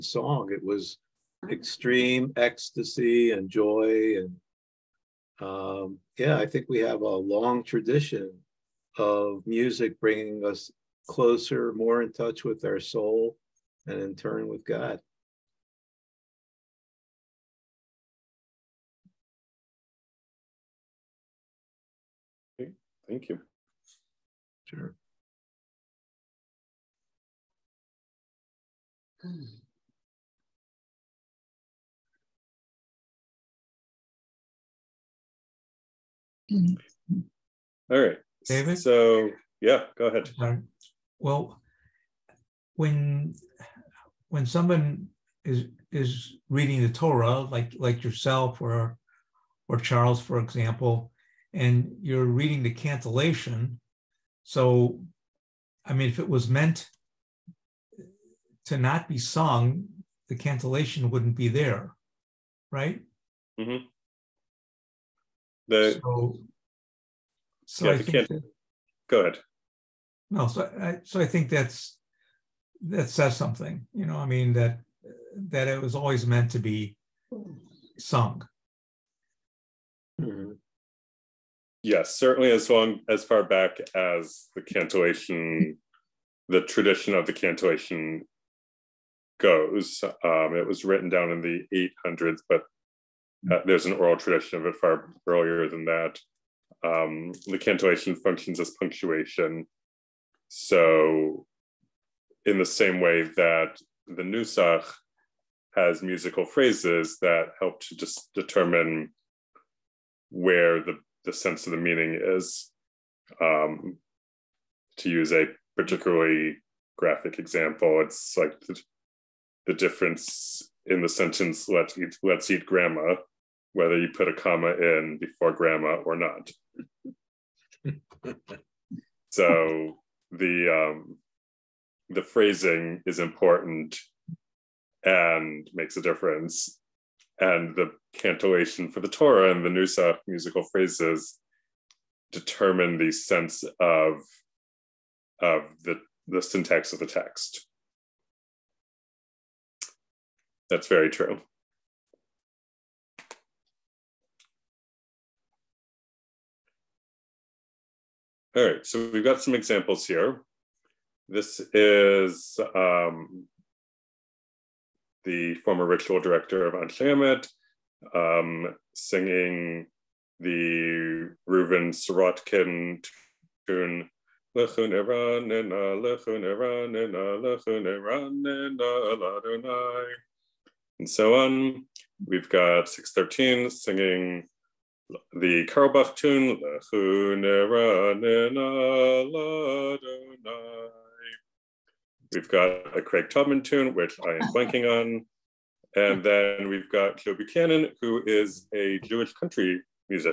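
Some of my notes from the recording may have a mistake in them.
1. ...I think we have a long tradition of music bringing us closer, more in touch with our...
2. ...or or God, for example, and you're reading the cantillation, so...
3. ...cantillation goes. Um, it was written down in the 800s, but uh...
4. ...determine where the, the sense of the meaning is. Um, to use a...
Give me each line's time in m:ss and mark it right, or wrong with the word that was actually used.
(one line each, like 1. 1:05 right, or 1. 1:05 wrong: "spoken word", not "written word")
1. 0:06 right
2. 0:48 wrong: "Charles", not "God"
3. 1:27 right
4. 1:48 right.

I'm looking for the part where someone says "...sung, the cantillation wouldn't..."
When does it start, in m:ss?
0:59.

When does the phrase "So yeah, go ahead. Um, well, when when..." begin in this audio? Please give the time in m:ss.
0:38.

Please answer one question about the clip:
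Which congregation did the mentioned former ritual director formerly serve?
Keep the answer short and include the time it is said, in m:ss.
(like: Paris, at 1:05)
Anshe Emet, at 2:46.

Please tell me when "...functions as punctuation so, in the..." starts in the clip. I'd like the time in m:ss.
1:38.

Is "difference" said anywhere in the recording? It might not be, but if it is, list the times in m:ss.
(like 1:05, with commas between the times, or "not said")
1:59, 2:16.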